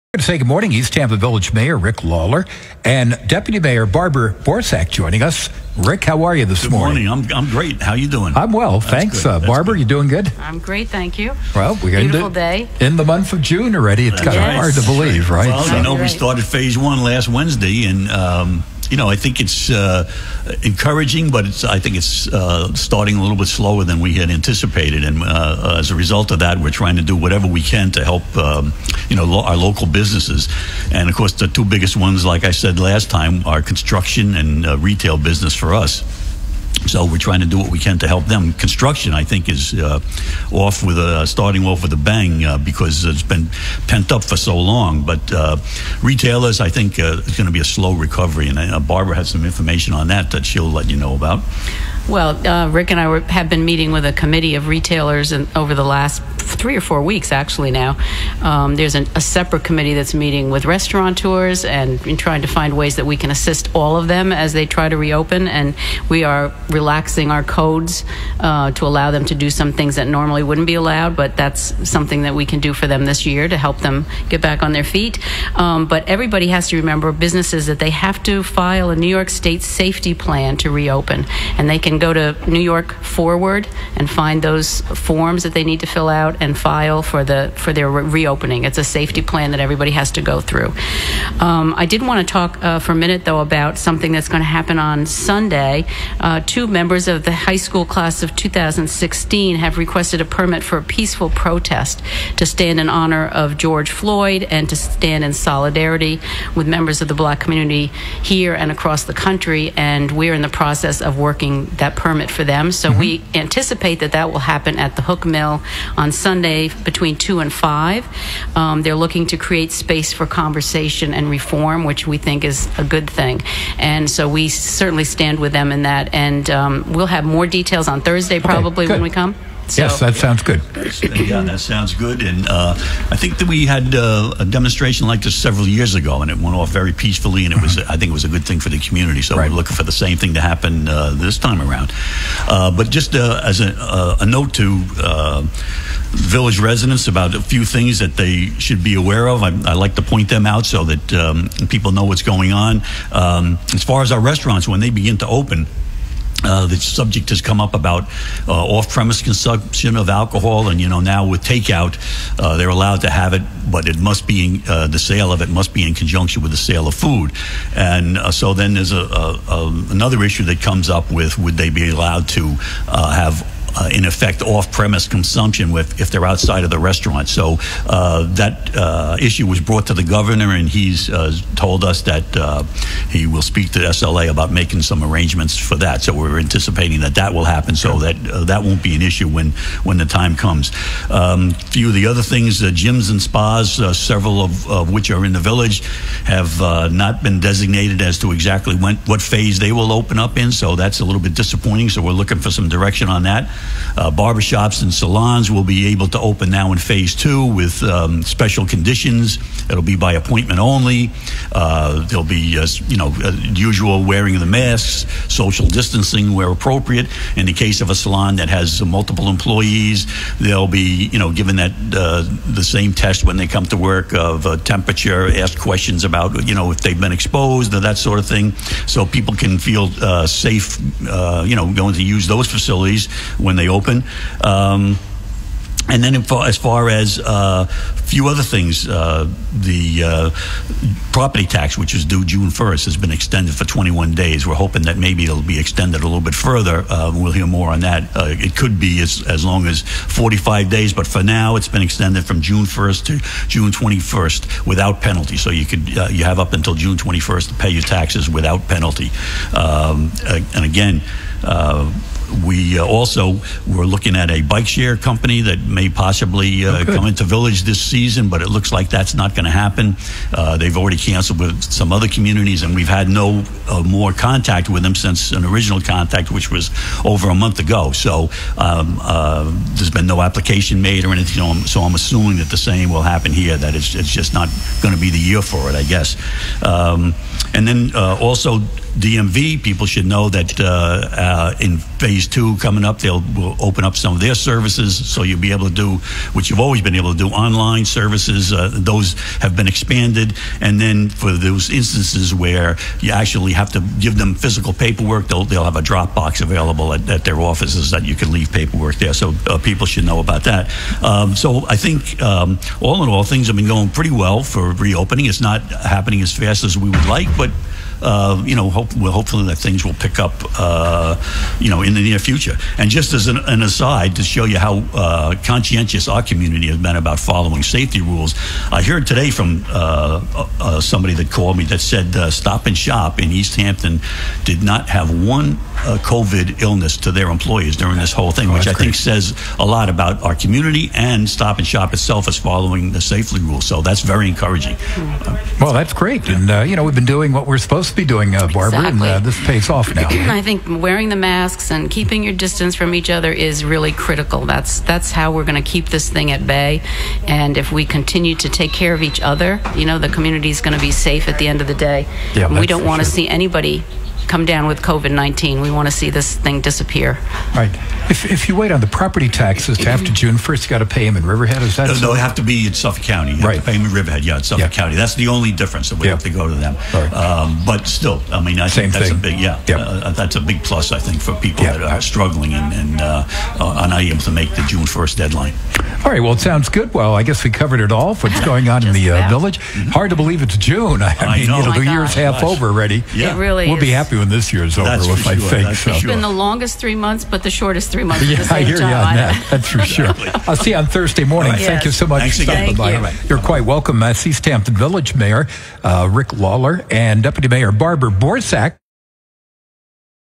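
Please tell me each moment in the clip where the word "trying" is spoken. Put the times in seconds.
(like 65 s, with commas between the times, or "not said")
26 s, 37 s, 62 s.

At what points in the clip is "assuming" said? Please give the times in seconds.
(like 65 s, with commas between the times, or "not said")
281 s.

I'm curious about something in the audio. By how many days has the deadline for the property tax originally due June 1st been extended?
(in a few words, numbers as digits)
21.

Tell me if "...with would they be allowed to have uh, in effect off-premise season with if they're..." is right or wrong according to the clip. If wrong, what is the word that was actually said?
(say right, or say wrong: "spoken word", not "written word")
wrong: "consumption", not "season".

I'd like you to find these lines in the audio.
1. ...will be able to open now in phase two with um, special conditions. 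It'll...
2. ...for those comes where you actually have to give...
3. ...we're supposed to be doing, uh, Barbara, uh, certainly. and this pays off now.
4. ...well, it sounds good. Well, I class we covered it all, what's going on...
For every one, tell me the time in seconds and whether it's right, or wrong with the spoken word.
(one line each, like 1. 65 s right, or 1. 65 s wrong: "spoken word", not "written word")
1. 205 s right
2. 301 s wrong: "instances", not "comes"
3. 347 s wrong: "exactly", not "certainly"
4. 386 s wrong: "guess", not "class".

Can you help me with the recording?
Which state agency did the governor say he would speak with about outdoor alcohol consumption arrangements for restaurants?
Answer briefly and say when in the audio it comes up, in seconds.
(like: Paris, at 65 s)
SLA, at 183 s.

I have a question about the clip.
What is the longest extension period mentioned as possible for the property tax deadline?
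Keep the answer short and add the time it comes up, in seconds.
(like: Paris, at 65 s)
45 days, at 249 s.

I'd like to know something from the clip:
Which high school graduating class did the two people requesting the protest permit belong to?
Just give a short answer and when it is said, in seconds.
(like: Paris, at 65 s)
2016, at 97 s.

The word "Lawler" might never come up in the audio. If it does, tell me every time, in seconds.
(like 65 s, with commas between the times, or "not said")
2 s, 406 s.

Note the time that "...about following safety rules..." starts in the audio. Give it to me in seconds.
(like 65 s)
326 s.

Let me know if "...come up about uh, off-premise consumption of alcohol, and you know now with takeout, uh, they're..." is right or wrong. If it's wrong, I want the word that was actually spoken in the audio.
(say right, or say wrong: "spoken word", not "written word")
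right.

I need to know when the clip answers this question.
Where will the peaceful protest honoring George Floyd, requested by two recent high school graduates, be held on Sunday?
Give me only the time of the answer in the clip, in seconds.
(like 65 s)
115 s.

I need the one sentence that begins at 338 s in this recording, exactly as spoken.
think says a lot about our community and Stop and Shop itself is following the safely rule.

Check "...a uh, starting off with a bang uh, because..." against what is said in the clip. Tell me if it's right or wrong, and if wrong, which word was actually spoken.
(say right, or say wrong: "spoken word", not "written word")
right.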